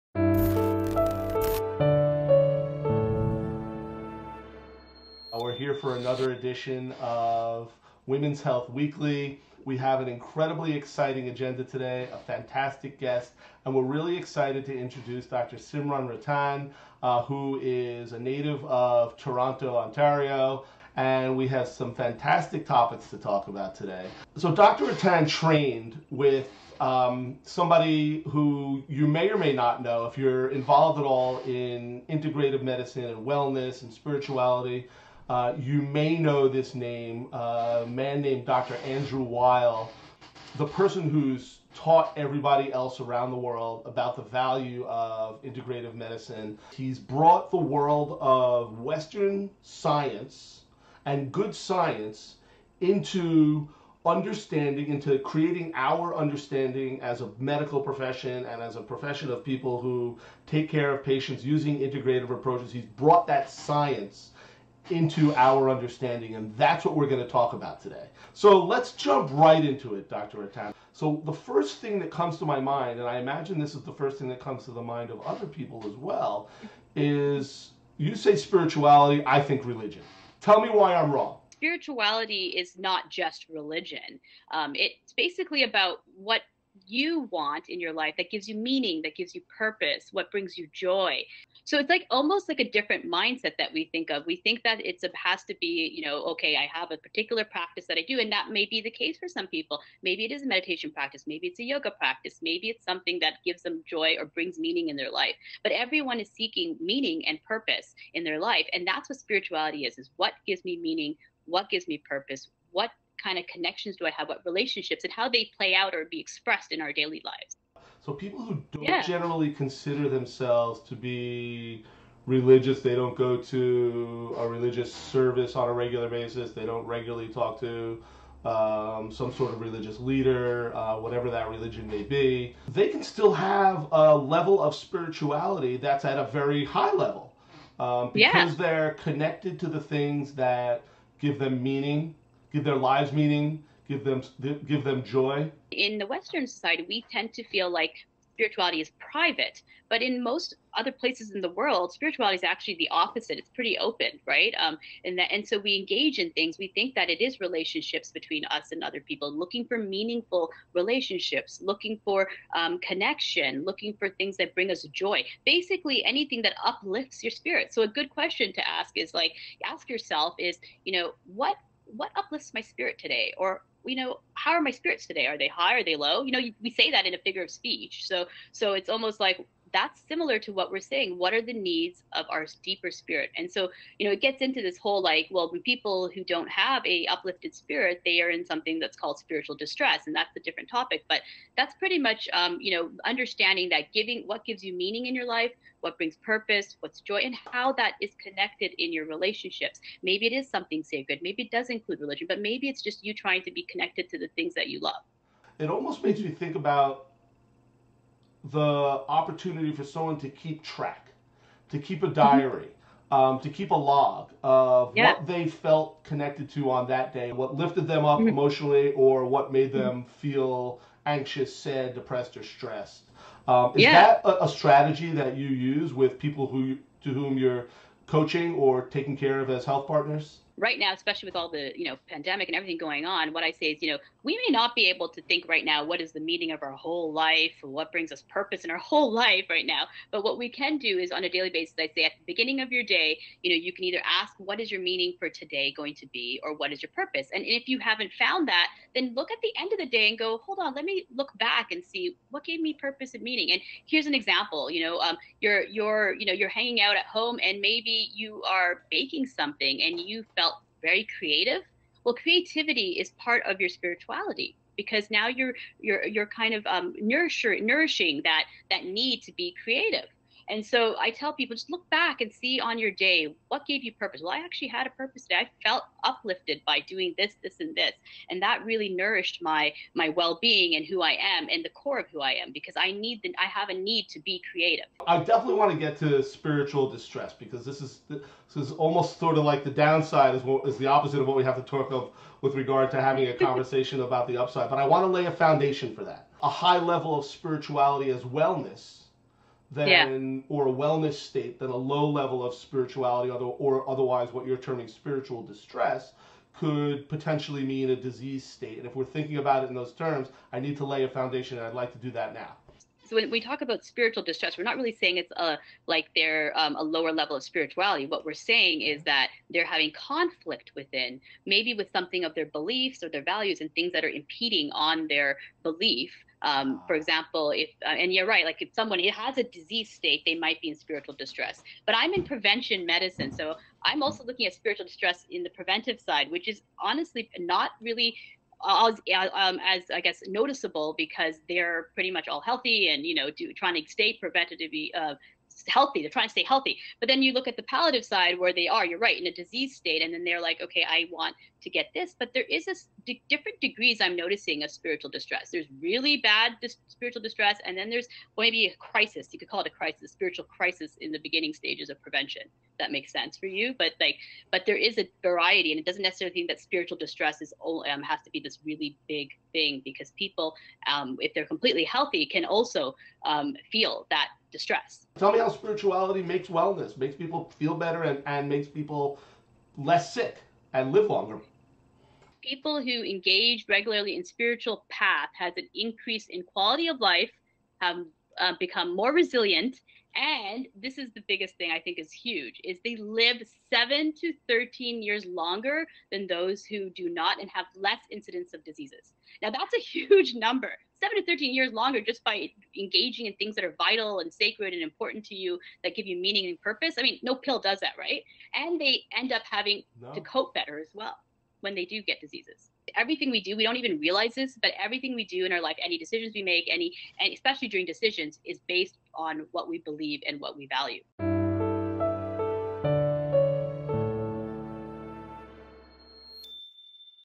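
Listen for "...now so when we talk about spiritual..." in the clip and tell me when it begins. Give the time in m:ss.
5:12.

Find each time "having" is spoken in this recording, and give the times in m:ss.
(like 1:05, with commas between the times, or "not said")
4:52, 5:19, 6:49.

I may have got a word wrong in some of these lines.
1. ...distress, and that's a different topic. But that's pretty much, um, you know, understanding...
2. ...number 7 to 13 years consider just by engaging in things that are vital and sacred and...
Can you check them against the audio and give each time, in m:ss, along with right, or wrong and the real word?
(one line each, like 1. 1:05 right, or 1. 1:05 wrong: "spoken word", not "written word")
1. 3:09 right
2. 6:40 wrong: "longer", not "consider".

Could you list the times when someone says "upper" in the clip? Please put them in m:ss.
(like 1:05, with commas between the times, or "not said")
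not said.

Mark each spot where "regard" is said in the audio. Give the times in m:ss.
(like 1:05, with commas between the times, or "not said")
4:52.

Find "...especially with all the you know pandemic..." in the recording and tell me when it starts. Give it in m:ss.
3:50.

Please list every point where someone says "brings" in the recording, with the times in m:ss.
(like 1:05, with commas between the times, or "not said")
1:30, 1:44, 2:44, 3:15, 3:57.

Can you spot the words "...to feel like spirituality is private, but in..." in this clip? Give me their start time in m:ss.
2:27.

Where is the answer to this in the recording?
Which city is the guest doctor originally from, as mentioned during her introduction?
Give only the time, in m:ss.
0:19.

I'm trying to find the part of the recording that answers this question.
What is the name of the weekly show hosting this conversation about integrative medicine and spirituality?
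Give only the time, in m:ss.
0:08.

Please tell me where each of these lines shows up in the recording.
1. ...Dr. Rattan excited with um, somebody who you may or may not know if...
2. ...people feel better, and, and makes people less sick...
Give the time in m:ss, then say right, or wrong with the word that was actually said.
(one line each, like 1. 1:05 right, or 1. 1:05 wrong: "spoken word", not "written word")
1. 0:24 wrong: "trained", not "excited"
2. 6:17 right.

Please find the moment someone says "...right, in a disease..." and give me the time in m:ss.
5:48.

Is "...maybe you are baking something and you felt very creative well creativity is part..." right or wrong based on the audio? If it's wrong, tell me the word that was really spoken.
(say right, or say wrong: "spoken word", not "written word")
right.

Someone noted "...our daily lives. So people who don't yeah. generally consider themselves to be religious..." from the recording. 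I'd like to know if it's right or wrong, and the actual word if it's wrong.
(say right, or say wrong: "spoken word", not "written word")
right.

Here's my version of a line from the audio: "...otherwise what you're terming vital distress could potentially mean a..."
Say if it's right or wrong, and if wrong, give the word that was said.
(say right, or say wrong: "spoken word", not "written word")
wrong: "spiritual", not "vital".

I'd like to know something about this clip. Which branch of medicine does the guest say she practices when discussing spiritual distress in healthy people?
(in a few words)
prevention medicine.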